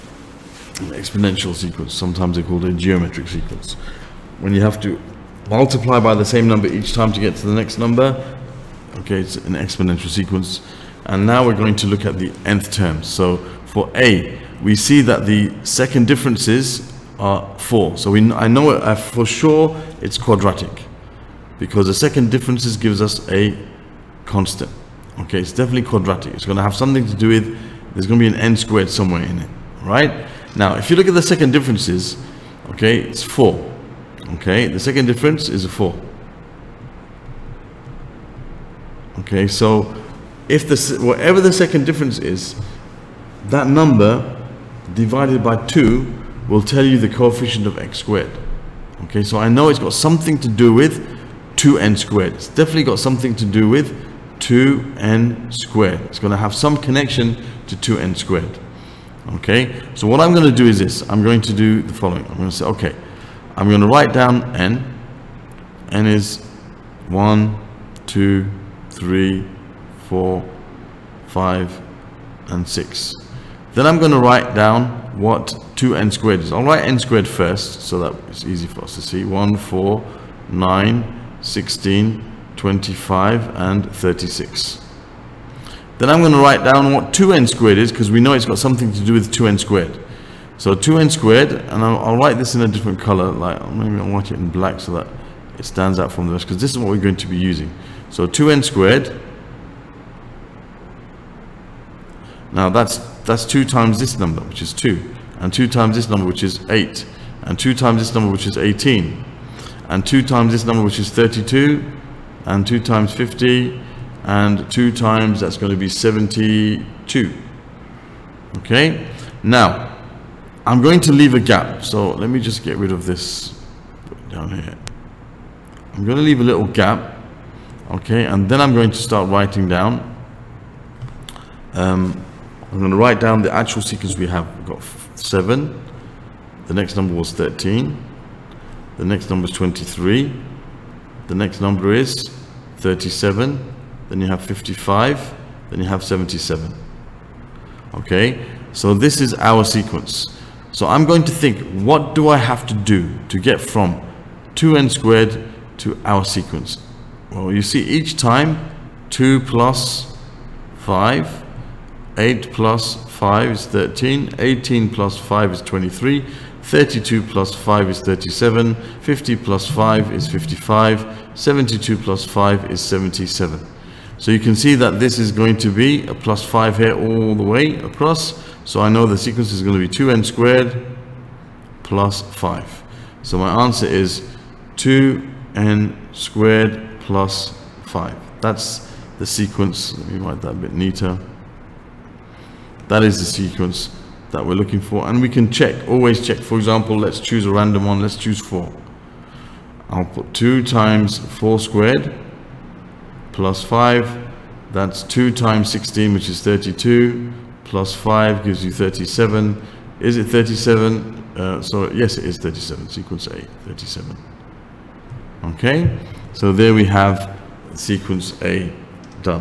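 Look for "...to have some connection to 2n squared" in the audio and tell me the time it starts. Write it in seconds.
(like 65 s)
56 s.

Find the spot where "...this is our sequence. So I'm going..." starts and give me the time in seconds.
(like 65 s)
148 s.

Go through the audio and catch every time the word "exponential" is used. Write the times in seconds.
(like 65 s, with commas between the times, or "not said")
0 s, 9 s.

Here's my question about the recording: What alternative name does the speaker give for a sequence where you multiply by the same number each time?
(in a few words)
geometric sequence.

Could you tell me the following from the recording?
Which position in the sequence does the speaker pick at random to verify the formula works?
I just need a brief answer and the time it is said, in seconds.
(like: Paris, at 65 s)
4, at 198 s.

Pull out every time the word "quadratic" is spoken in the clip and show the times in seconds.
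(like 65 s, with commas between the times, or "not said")
20 s, 25 s.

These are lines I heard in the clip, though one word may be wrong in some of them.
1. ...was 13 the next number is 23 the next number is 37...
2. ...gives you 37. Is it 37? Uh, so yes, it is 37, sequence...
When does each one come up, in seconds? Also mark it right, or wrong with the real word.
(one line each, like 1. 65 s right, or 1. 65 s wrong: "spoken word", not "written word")
1. 137 s right
2. 208 s right.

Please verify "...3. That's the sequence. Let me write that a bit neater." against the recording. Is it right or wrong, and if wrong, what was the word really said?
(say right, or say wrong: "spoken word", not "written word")
wrong: "5", not "3".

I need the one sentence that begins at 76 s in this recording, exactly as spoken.
I'll write n squared first so that it's easy for us to see.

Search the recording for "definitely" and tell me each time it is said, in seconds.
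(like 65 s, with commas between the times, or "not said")
25 s, 52 s.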